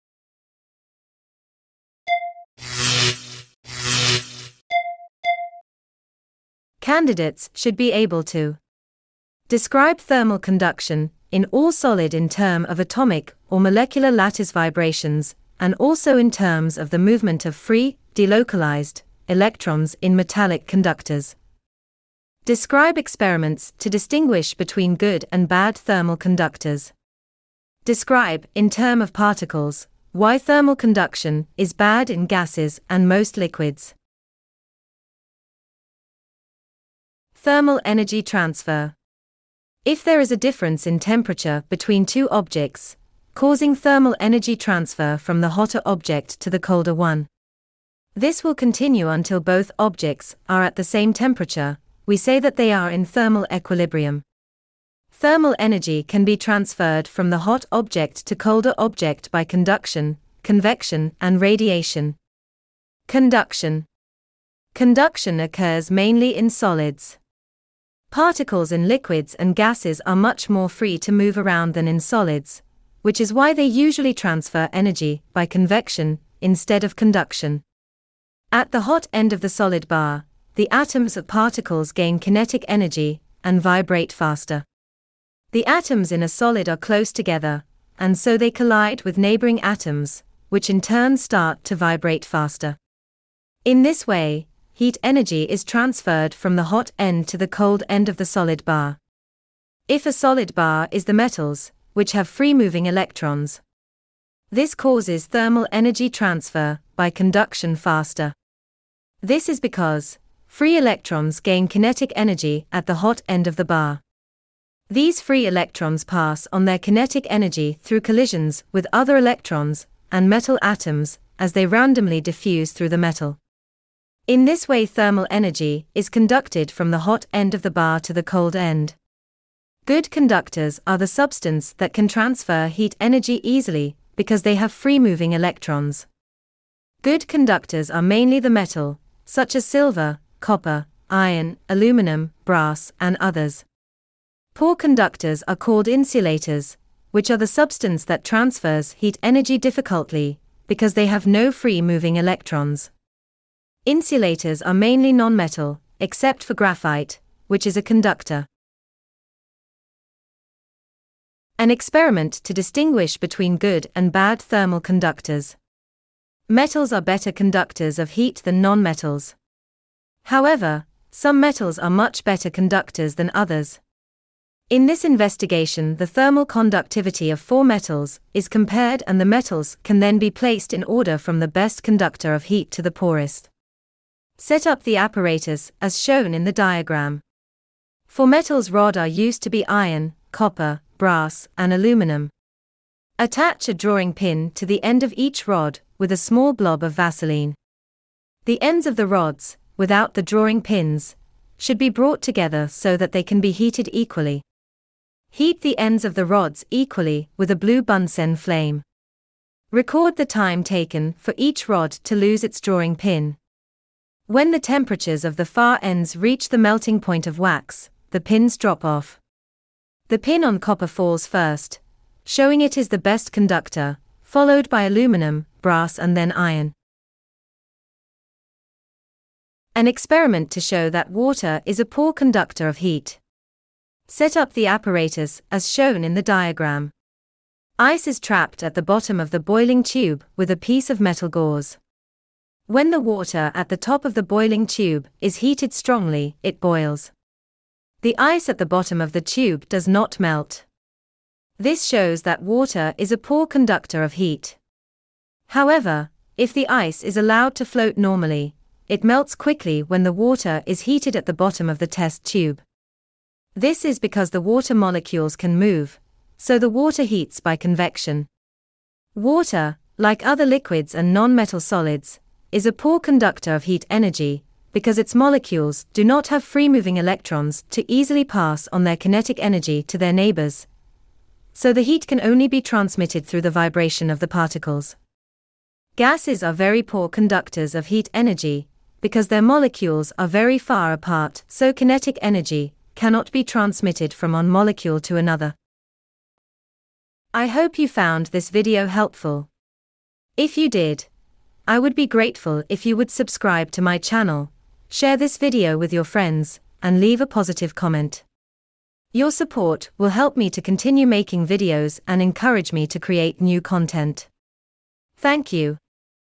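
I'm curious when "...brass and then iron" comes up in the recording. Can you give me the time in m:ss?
3:45.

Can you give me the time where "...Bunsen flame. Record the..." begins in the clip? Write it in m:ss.
3:27.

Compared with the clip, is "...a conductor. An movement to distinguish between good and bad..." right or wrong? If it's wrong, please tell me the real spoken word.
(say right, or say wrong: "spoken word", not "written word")
wrong: "experiment", not "movement".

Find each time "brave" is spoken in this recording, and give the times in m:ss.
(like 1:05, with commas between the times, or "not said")
not said.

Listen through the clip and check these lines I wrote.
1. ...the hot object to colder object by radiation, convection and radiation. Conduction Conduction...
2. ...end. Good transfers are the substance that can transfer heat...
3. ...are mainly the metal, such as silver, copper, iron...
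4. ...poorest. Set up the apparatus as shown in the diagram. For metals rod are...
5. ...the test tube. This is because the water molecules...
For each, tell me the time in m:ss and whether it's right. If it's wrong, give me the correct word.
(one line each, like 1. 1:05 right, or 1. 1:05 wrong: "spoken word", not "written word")
1. 0:57 wrong: "conduction", not "radiation"
2. 2:08 wrong: "conductors", not "transfers"
3. 2:17 right
4. 3:02 right
5. 4:21 right.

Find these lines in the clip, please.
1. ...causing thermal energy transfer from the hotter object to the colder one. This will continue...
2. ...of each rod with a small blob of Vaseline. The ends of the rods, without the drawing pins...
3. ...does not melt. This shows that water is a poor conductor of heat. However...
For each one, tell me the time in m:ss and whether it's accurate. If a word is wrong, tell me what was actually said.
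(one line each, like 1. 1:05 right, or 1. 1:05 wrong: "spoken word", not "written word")
1. 0:43 right
2. 3:15 right
3. 4:09 right.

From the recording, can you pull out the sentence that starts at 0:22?
Describe experiments to distinguish between good and bad thermal conductors.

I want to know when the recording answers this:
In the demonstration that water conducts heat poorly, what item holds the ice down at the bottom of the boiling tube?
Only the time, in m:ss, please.
4:01.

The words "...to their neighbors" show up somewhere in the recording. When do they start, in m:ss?
4:39.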